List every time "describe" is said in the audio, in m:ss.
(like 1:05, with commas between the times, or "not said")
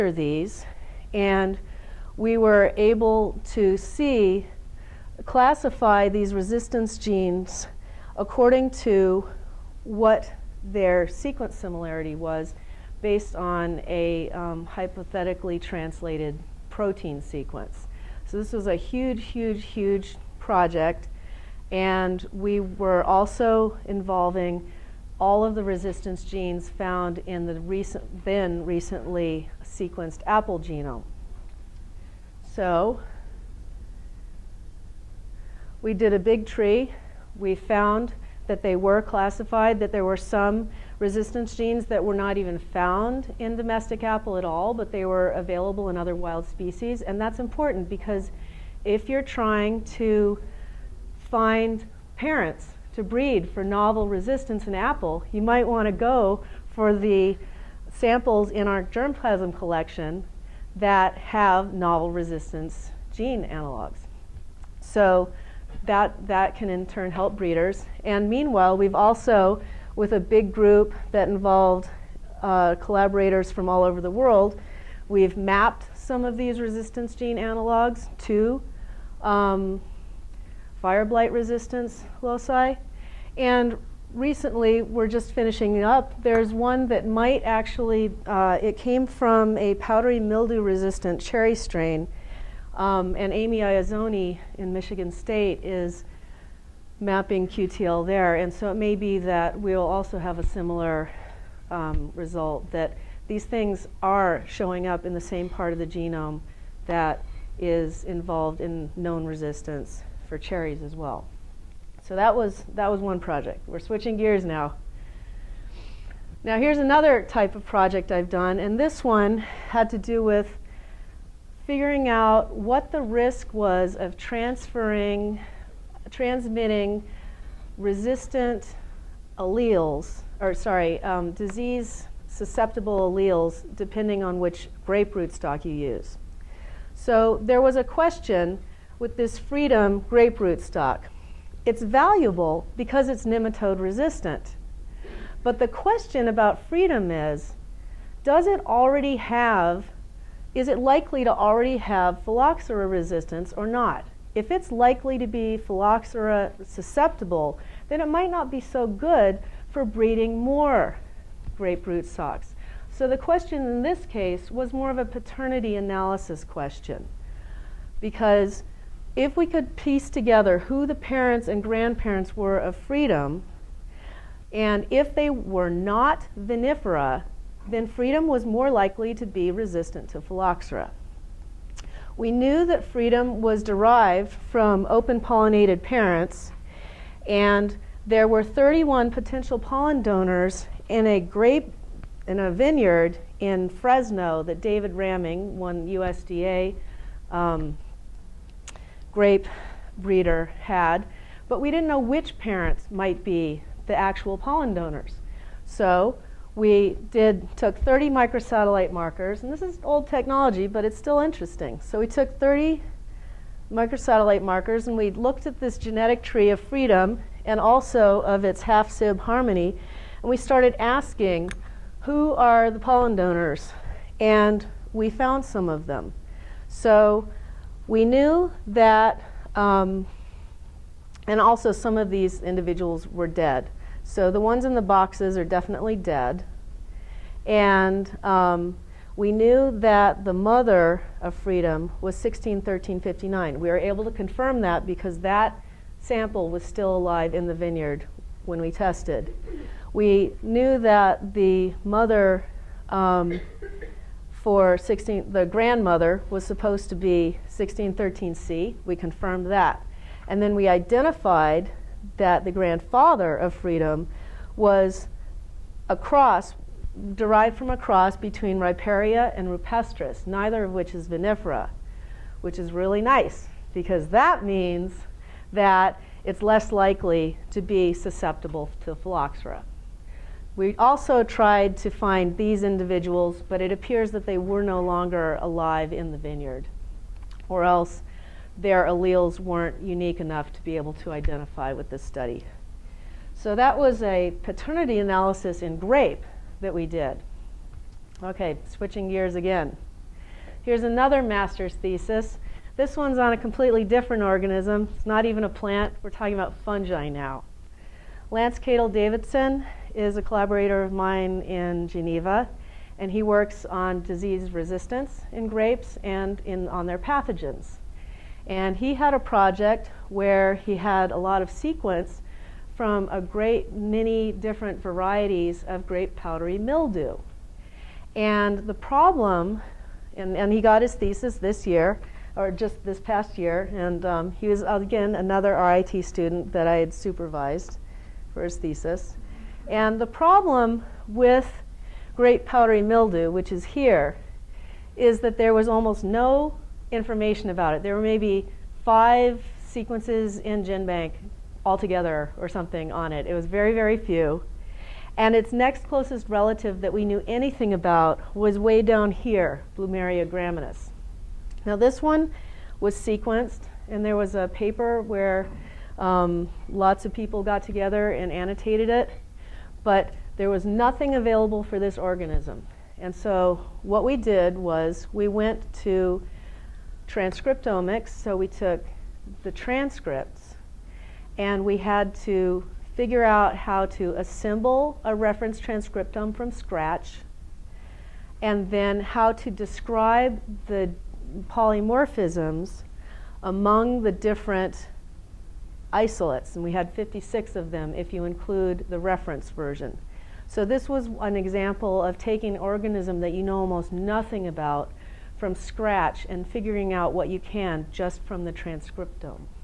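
6:29.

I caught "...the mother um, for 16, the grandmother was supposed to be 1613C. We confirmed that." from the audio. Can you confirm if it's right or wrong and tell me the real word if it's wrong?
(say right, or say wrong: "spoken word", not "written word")
right.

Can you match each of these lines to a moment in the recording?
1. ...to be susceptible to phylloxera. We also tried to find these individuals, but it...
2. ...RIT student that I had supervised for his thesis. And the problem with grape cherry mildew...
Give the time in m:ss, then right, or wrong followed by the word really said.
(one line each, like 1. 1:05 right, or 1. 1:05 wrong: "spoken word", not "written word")
1. 4:37 right
2. 5:35 wrong: "powdery", not "cherry".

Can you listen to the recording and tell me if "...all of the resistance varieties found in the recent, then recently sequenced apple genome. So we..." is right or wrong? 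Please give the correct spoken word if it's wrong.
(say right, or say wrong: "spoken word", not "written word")
wrong: "genes", not "varieties".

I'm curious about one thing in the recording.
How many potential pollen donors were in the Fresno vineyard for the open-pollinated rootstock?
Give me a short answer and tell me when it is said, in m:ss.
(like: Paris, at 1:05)
31, at 3:08.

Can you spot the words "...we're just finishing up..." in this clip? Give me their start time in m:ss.
1:24.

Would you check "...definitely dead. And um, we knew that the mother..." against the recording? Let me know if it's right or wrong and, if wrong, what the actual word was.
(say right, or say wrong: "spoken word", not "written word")
right.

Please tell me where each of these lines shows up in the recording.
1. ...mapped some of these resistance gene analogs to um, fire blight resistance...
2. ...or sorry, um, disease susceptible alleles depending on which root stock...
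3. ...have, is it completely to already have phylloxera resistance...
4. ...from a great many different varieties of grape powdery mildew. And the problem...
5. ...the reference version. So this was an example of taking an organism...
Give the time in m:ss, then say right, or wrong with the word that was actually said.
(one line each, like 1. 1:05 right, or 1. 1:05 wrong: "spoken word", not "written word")
1. 1:15 right
2. 2:10 right
3. 2:29 wrong: "likely", not "completely"
4. 5:22 right
5. 6:38 right.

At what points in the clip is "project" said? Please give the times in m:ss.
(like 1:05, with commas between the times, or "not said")
0:20, 1:53, 1:57, 5:19.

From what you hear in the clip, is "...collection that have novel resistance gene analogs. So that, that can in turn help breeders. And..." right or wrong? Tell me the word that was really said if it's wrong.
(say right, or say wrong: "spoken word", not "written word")
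right.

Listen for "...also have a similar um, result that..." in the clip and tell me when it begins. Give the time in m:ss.
1:39.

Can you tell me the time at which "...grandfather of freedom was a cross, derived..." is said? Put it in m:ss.
4:22.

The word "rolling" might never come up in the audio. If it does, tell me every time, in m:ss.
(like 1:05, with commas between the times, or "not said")
not said.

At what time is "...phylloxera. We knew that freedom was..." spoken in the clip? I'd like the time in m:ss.
3:00.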